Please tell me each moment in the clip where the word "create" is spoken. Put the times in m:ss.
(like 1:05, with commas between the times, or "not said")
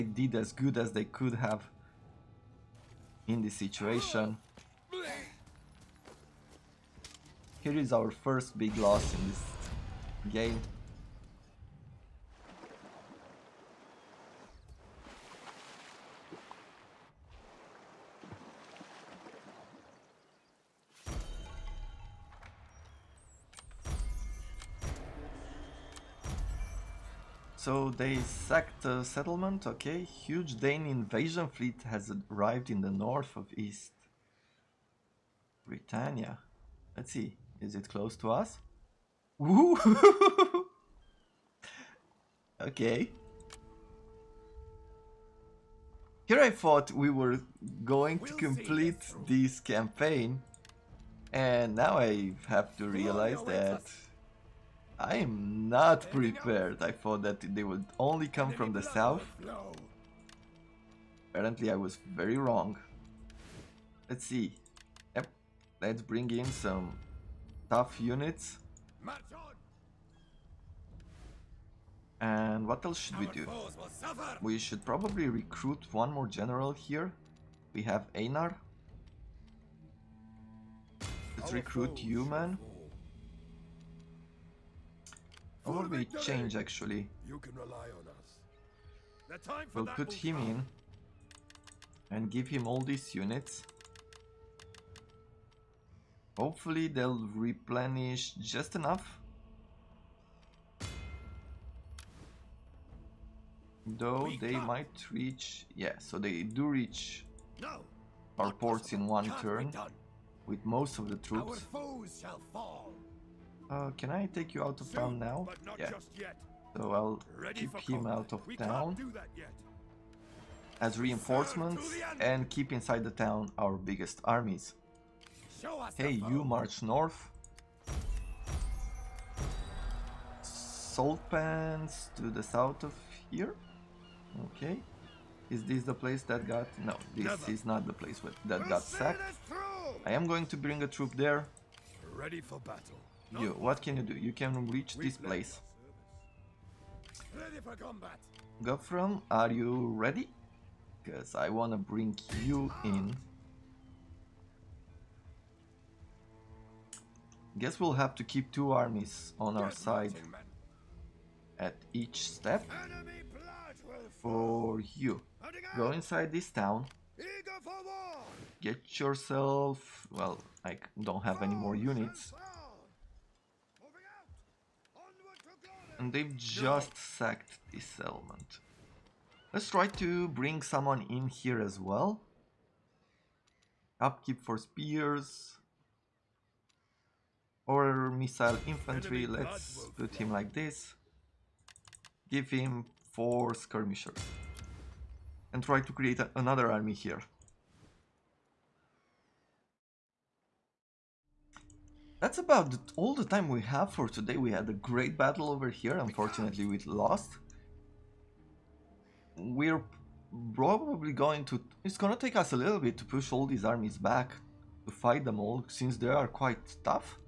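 3:15.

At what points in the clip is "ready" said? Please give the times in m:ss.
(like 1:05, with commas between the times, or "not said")
1:57, 2:22, 2:29.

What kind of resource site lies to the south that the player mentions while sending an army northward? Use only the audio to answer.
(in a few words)
salt pans.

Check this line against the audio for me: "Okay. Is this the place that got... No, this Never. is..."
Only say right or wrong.
right.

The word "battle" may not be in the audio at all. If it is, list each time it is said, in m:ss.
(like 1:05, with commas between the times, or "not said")
2:22, 3:25.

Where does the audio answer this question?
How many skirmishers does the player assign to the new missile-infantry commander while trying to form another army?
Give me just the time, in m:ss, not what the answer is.
3:13.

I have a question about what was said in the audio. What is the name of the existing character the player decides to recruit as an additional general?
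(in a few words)
Einar.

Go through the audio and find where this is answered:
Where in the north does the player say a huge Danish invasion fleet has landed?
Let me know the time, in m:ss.
0:33.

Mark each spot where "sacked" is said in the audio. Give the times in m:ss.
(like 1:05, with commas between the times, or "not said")
0:28, 2:18, 2:56.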